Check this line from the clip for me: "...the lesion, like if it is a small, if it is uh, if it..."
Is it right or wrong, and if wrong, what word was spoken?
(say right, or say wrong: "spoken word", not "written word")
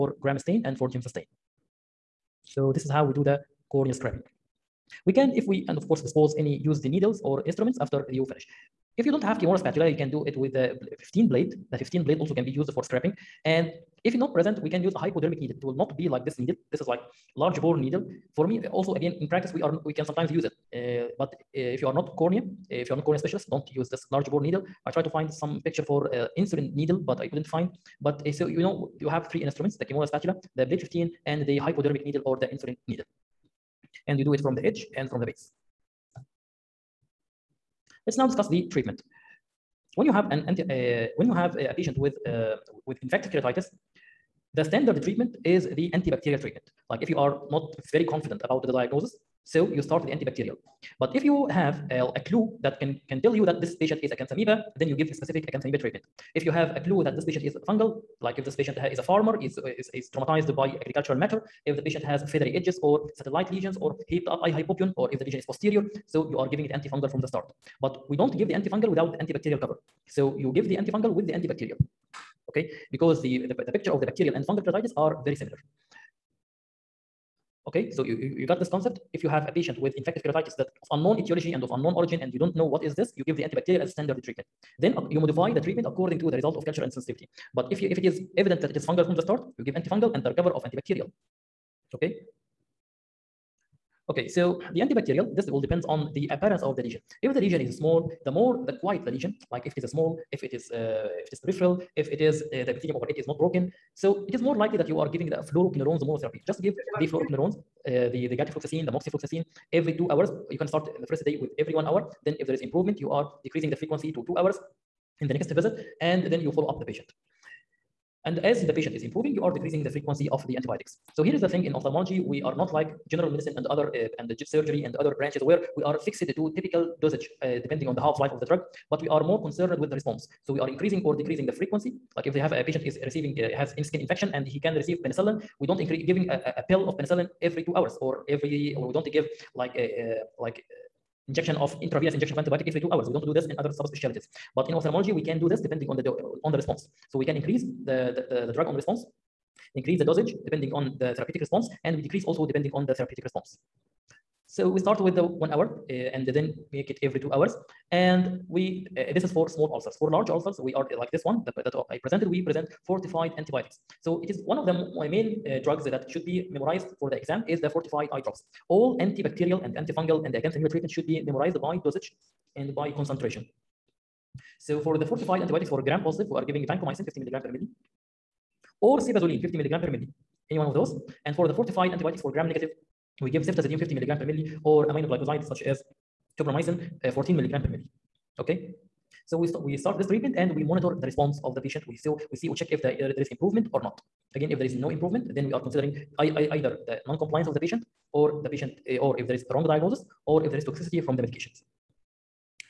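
right.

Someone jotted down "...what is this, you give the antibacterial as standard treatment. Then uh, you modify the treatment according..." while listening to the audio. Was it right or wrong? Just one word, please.
right.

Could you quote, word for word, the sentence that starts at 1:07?
But we don't give the antifungal without the antibacterial cover.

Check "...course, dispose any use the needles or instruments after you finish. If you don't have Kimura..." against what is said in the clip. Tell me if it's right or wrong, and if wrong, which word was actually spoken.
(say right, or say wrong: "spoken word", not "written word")
right.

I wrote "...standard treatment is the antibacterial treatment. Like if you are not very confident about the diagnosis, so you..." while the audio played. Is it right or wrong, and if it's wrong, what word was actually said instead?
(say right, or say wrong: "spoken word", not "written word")
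right.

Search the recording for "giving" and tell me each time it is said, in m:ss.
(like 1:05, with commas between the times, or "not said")
1:06, 1:45, 2:16, 2:56.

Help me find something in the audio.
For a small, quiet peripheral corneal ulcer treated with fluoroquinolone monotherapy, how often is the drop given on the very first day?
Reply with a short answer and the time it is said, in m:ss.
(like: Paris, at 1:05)
every 1 hour, at 1:51.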